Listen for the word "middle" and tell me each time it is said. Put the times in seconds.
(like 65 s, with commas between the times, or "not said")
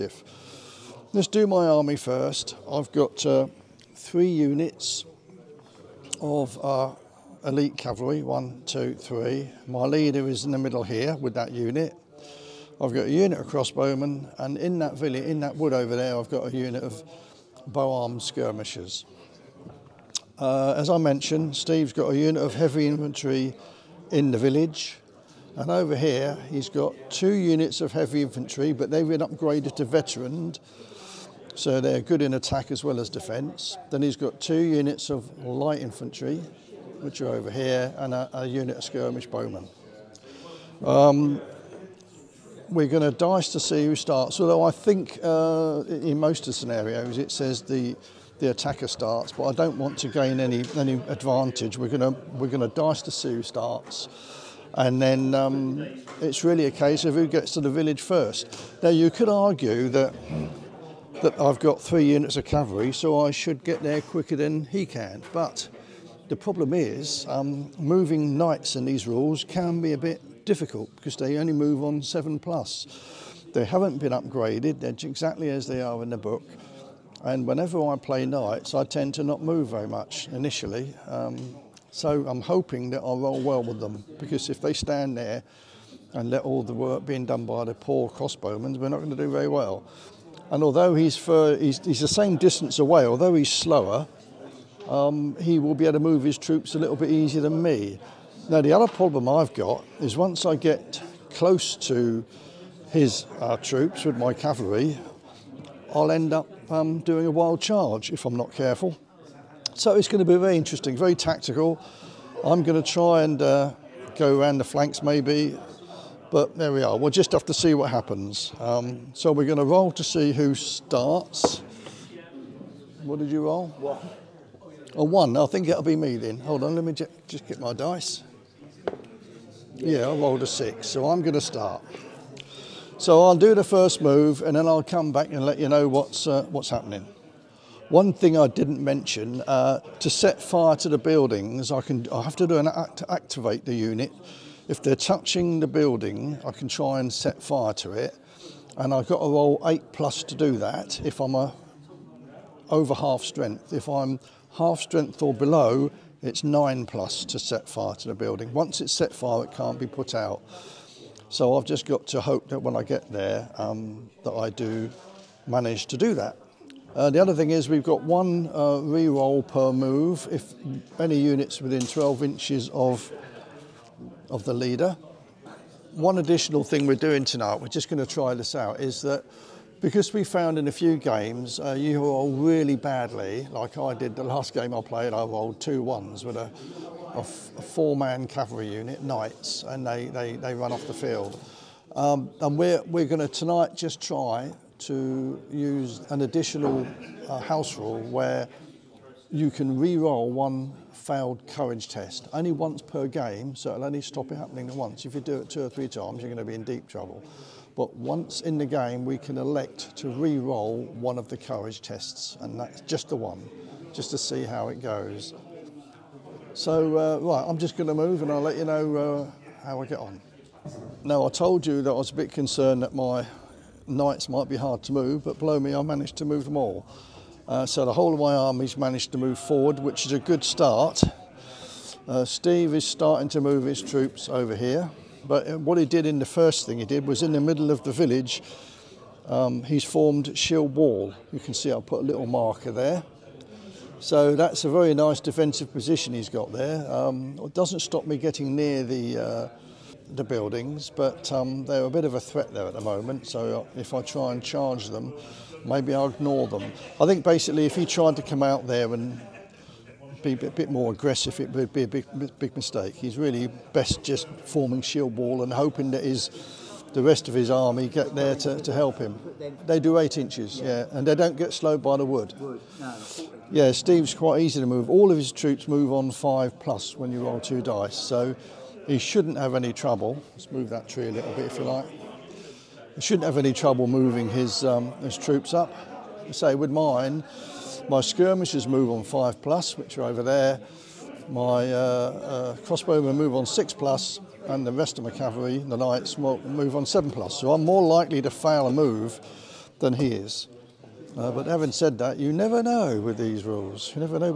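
10 s, 237 s.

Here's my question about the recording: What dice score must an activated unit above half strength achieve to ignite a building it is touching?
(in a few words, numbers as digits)
8+.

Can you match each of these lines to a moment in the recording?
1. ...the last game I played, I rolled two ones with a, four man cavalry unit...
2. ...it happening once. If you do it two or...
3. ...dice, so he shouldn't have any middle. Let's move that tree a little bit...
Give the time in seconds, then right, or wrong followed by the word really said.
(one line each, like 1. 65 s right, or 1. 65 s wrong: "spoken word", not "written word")
1. 184 s right
2. 204 s right
3. 277 s wrong: "trouble", not "middle".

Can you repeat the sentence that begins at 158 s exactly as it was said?
Once it's set fire, it can't be put out.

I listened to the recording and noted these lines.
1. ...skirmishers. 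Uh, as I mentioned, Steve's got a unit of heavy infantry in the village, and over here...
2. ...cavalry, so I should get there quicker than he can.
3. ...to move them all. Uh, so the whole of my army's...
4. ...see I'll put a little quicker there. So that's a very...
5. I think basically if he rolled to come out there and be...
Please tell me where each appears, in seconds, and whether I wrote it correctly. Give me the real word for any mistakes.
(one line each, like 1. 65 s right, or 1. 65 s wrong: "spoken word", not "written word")
1. 18 s right
2. 62 s right
3. 226 s right
4. 241 s wrong: "marker", not "quicker"
5. 256 s wrong: "tried", not "rolled".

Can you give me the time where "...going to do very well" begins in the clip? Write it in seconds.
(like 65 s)
88 s.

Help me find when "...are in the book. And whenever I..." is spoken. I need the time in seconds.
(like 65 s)
75 s.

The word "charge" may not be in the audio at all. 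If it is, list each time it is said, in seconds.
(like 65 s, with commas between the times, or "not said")
107 s, 254 s.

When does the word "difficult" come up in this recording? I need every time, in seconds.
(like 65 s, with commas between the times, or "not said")
70 s.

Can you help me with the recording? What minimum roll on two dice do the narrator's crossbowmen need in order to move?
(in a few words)
6+.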